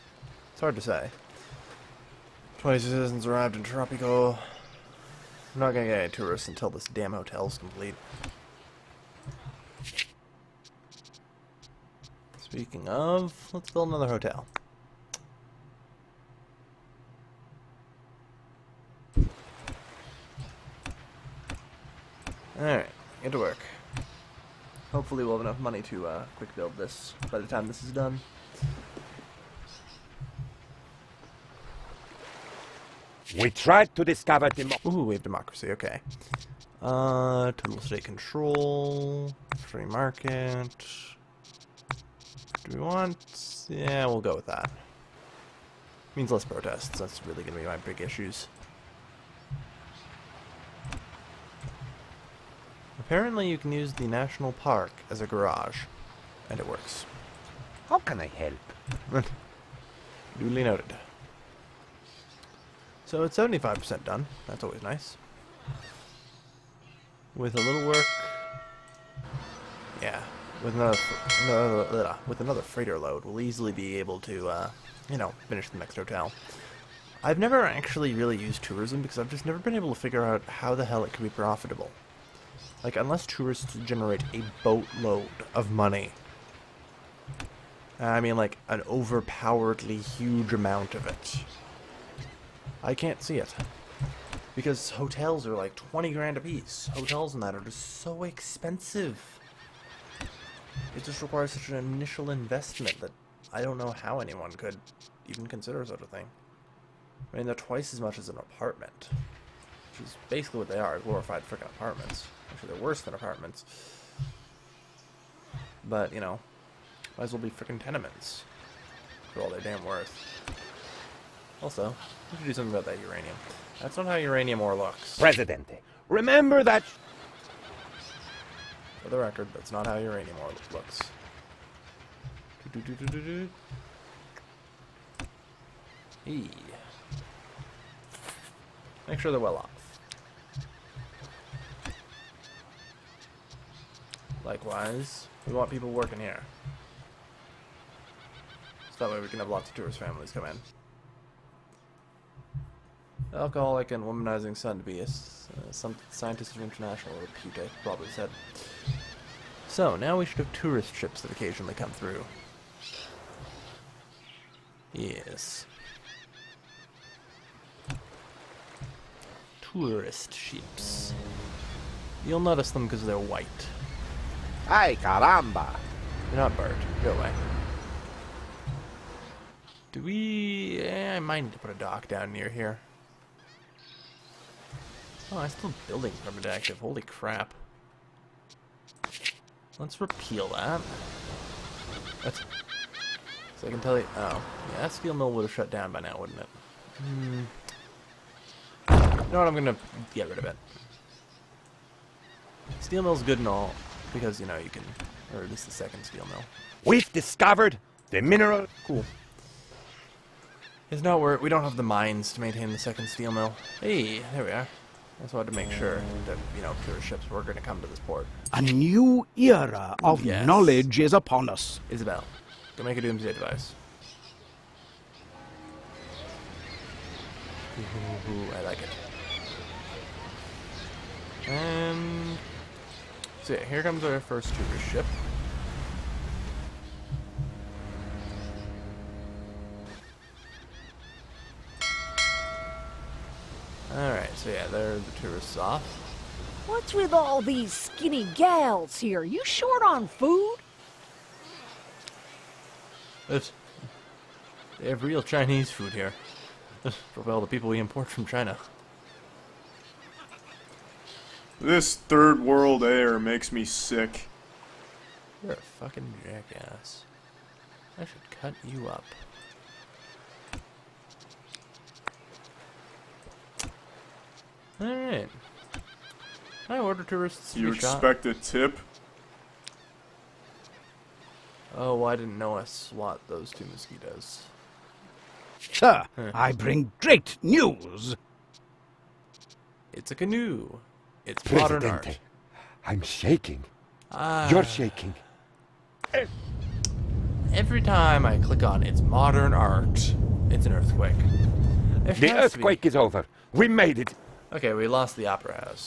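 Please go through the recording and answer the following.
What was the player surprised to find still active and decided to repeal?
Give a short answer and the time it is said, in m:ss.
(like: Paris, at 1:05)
Building permit, at 3:05.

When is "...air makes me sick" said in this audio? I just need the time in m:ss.
4:22.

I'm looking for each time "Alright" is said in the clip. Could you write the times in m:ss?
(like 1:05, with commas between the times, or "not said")
4:03, 4:34.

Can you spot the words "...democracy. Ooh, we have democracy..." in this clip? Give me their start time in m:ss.
0:34.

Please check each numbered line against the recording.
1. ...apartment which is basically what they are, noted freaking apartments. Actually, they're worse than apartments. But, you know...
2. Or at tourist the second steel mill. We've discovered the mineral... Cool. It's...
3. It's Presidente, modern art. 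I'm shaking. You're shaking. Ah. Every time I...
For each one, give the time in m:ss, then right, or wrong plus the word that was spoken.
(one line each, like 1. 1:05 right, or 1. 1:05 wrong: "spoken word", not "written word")
1. 1:48 wrong: "glorified", not "noted"
2. 3:25 wrong: "least", not "tourist"
3. 4:51 right.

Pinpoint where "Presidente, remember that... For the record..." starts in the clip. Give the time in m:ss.
2:05.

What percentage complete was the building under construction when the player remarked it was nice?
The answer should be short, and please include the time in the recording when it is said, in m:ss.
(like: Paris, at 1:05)
75%, at 1:03.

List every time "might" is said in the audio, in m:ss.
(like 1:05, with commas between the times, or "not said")
1:57, 3:01.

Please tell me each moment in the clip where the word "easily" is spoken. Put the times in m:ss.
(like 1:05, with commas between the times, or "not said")
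1:13.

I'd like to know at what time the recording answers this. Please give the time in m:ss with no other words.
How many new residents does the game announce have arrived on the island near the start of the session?
0:02.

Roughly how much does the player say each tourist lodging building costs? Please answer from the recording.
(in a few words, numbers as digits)
20 grand.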